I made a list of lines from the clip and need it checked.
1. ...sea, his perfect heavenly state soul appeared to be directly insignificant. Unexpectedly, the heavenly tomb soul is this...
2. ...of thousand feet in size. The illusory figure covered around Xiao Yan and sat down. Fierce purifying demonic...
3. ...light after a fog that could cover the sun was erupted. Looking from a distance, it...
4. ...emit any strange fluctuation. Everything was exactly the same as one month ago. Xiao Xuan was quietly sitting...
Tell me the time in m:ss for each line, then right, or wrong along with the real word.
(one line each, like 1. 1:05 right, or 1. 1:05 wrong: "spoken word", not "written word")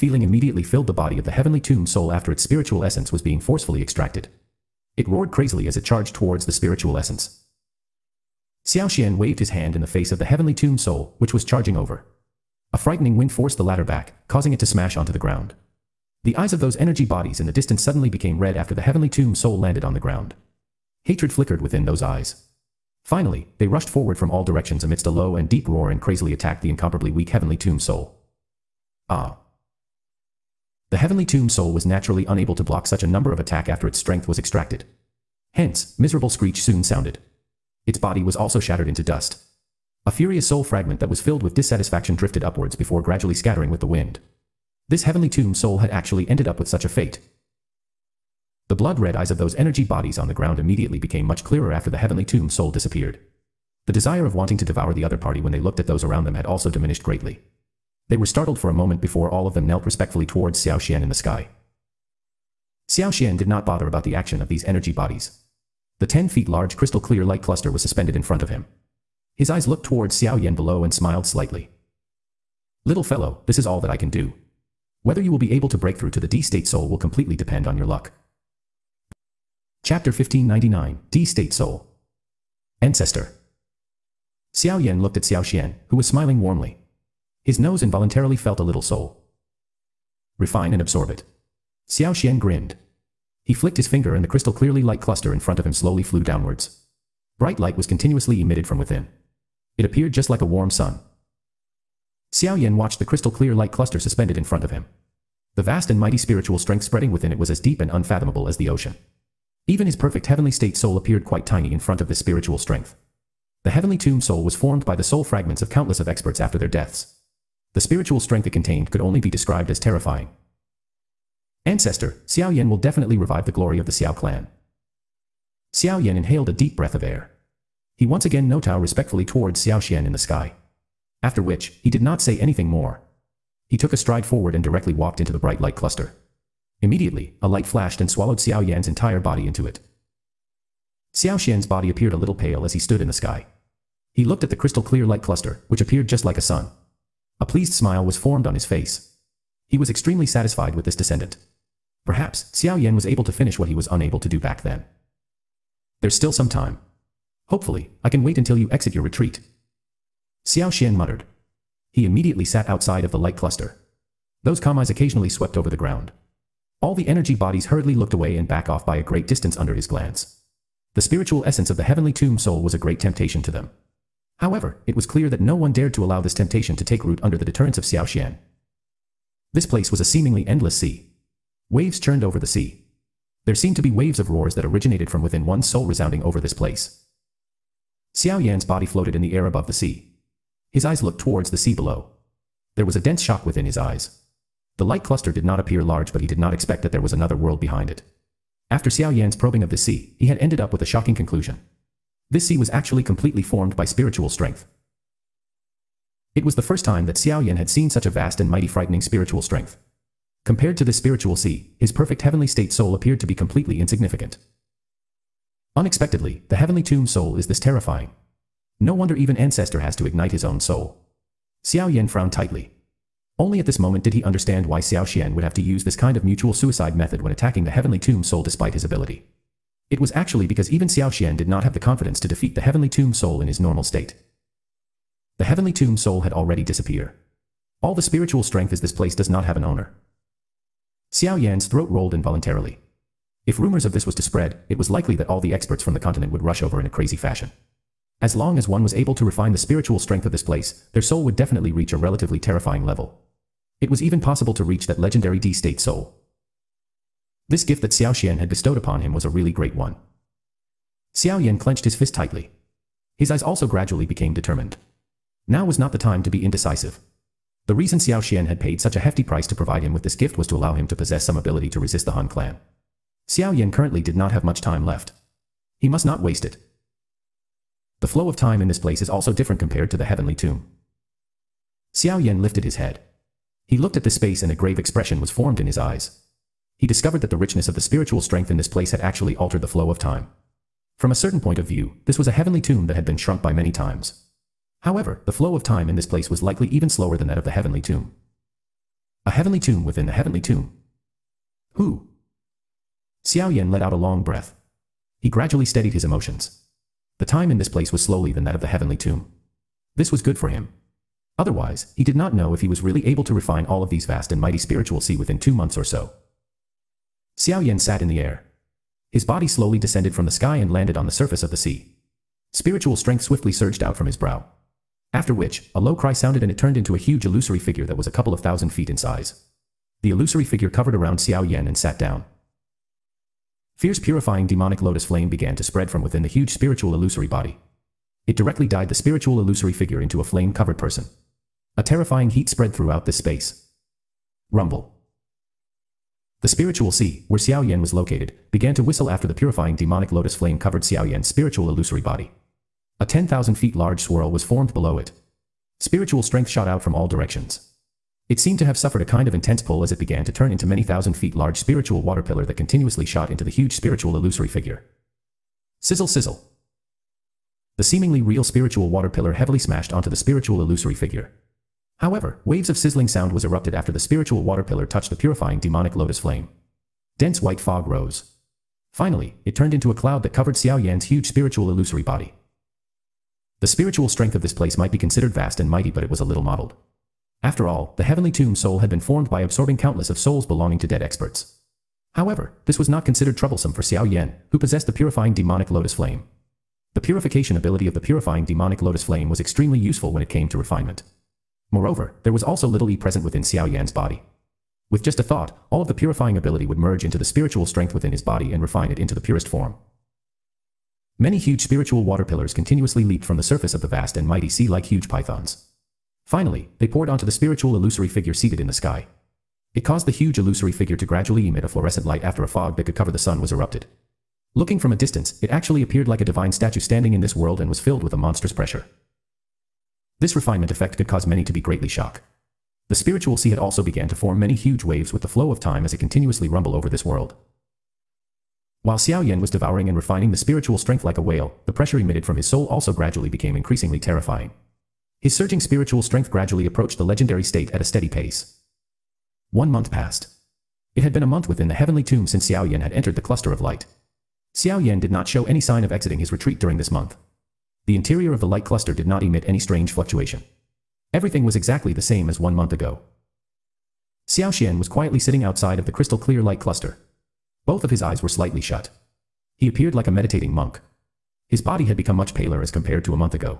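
1. 3:31 wrong: "completely", not "directly"
2. 5:28 right
3. 7:02 right
4. 7:39 right.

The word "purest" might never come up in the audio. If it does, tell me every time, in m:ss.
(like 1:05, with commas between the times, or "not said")
6:49.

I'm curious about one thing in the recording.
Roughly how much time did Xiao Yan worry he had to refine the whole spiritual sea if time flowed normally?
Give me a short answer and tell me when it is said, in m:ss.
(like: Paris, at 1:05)
two months, at 5:15.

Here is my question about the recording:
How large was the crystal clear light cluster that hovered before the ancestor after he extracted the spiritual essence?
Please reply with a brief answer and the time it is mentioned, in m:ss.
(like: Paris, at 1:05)
10 feet, at 1:06.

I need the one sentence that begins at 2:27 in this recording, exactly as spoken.
A pleased smile was formed on his face.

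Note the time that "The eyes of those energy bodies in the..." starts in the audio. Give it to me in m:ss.
0:16.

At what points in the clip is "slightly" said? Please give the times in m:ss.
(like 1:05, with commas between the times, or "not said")
1:11, 7:48.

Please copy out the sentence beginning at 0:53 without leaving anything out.
The desire of wanting to devour the other party when they looked at those around them had also diminished greatly.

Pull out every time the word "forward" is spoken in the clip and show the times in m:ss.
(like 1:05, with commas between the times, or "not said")
0:23, 2:14.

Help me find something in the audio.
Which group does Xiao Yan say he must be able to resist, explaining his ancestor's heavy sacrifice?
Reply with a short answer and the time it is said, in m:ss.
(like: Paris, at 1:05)
Hun clan, at 4:32.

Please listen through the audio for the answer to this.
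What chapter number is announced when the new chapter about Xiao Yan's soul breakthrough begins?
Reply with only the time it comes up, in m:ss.
1:19.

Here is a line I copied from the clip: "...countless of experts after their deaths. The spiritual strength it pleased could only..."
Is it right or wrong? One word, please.
wrong.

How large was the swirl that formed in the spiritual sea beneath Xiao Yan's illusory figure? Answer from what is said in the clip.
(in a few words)
10,000 feet.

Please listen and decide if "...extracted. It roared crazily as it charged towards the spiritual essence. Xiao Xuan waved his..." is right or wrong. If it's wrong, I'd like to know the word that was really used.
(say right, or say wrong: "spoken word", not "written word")
right.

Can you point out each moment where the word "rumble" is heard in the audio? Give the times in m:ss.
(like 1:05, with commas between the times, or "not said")
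5:44, 7:16.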